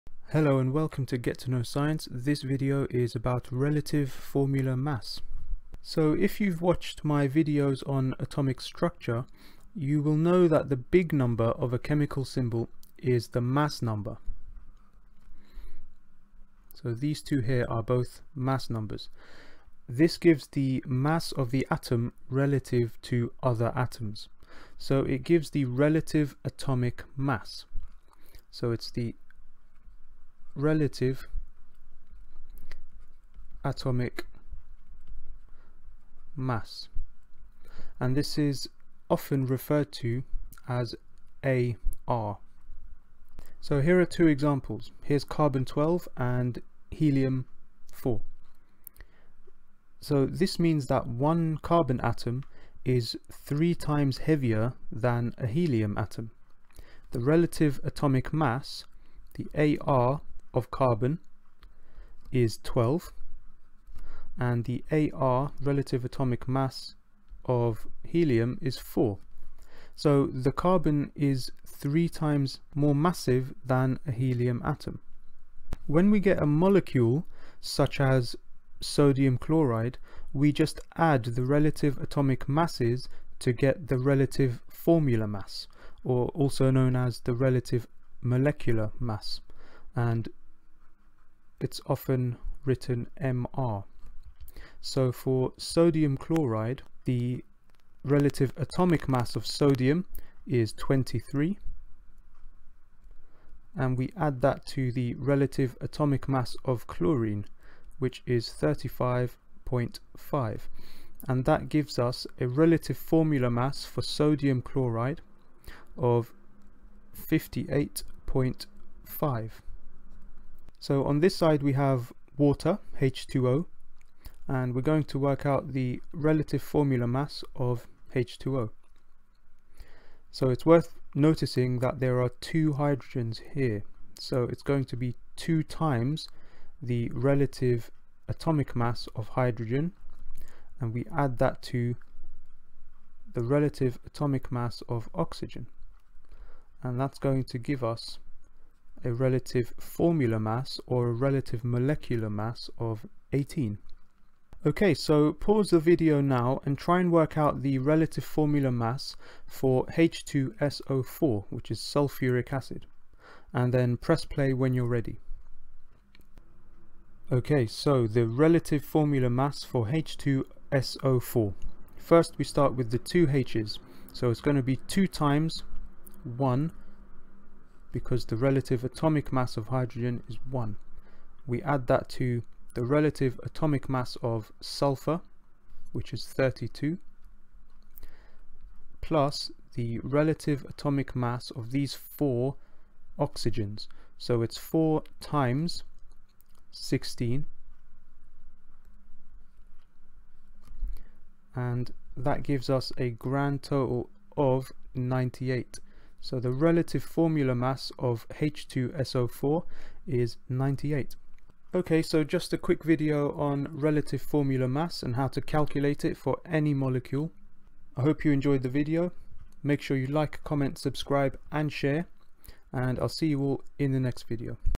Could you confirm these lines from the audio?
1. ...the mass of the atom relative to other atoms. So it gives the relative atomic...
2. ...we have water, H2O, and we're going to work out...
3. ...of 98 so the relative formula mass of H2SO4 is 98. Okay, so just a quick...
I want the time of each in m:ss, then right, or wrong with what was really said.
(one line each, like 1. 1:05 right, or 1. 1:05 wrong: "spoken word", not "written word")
1. 0:20 right
2. 2:01 right
3. 3:24 right.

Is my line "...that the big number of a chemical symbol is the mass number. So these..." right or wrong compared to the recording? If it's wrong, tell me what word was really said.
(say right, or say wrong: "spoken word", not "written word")
right.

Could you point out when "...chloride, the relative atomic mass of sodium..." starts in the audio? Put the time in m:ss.
1:36.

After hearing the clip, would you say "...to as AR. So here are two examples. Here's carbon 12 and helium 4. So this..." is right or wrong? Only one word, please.
right.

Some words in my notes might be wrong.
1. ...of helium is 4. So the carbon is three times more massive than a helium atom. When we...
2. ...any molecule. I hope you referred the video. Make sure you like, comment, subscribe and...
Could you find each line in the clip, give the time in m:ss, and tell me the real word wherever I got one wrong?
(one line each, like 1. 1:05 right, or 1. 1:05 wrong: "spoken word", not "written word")
1. 1:07 right
2. 3:36 wrong: "enjoyed", not "referred".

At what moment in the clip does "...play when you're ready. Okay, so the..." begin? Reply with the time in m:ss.
2:44.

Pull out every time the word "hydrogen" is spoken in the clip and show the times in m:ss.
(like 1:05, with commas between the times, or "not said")
2:12, 2:19, 2:59.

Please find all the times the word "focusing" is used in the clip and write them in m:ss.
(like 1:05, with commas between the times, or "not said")
not said.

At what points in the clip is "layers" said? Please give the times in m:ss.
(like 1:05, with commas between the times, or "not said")
not said.